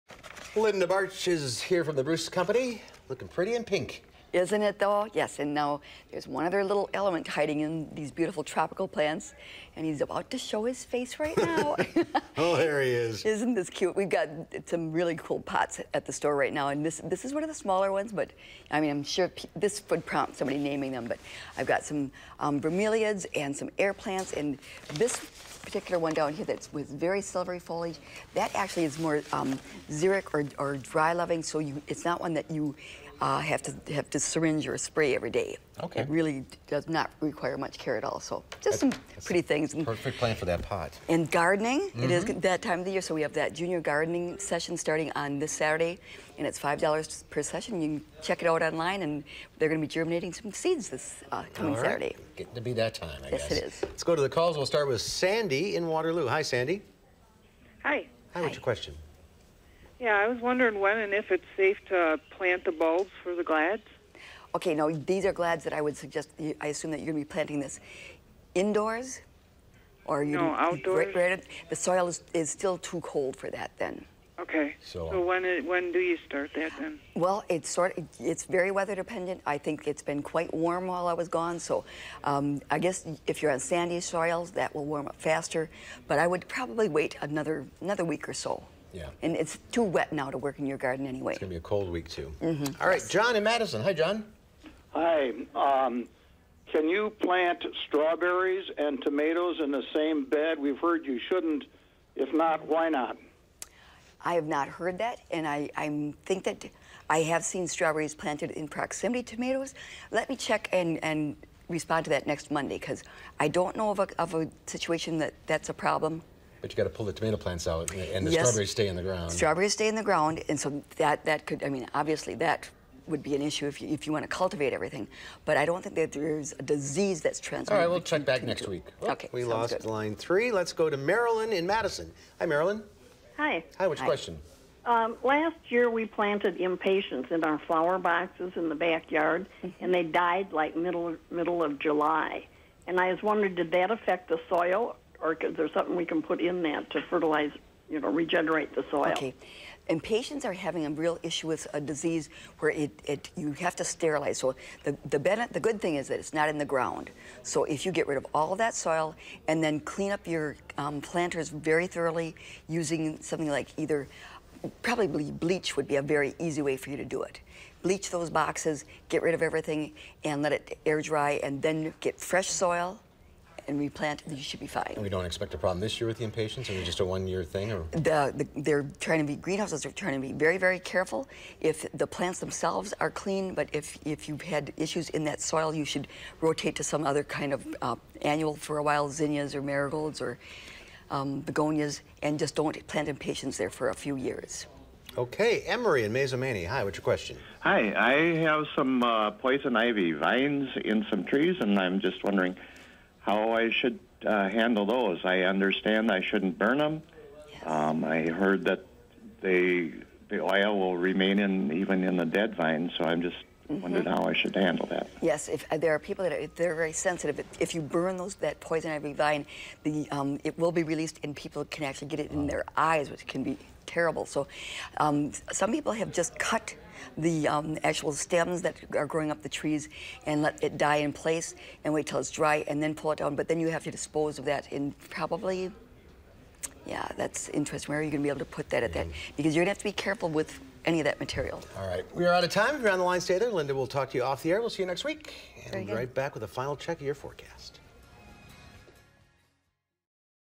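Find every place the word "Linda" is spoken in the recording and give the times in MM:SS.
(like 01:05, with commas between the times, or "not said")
00:00, 04:03.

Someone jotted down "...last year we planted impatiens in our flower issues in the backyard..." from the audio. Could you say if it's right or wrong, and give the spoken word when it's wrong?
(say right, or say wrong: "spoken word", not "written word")
wrong: "boxes", not "issues".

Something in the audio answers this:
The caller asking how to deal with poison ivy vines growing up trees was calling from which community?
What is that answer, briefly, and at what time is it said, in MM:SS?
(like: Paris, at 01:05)
Mazomanie, at 03:16.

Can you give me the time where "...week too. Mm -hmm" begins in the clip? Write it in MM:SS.
01:31.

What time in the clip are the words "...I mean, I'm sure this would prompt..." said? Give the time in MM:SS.
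00:18.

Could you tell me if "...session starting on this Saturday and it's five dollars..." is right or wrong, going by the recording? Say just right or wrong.
right.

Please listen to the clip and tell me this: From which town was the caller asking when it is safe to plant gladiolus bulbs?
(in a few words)
Waterloo.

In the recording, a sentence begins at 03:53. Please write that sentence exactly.
But then you have to dispose of that in probably, yeah, that's interesting.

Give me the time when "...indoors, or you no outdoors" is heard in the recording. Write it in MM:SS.
01:08.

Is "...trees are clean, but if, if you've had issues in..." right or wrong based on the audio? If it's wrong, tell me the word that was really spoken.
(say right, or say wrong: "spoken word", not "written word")
wrong: "themselves", not "trees".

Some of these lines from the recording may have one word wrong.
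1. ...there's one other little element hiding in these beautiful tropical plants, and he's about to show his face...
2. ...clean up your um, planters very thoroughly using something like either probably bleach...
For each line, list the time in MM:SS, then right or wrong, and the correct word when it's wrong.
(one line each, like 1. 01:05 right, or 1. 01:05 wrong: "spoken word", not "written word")
1. 00:06 right
2. 02:39 right.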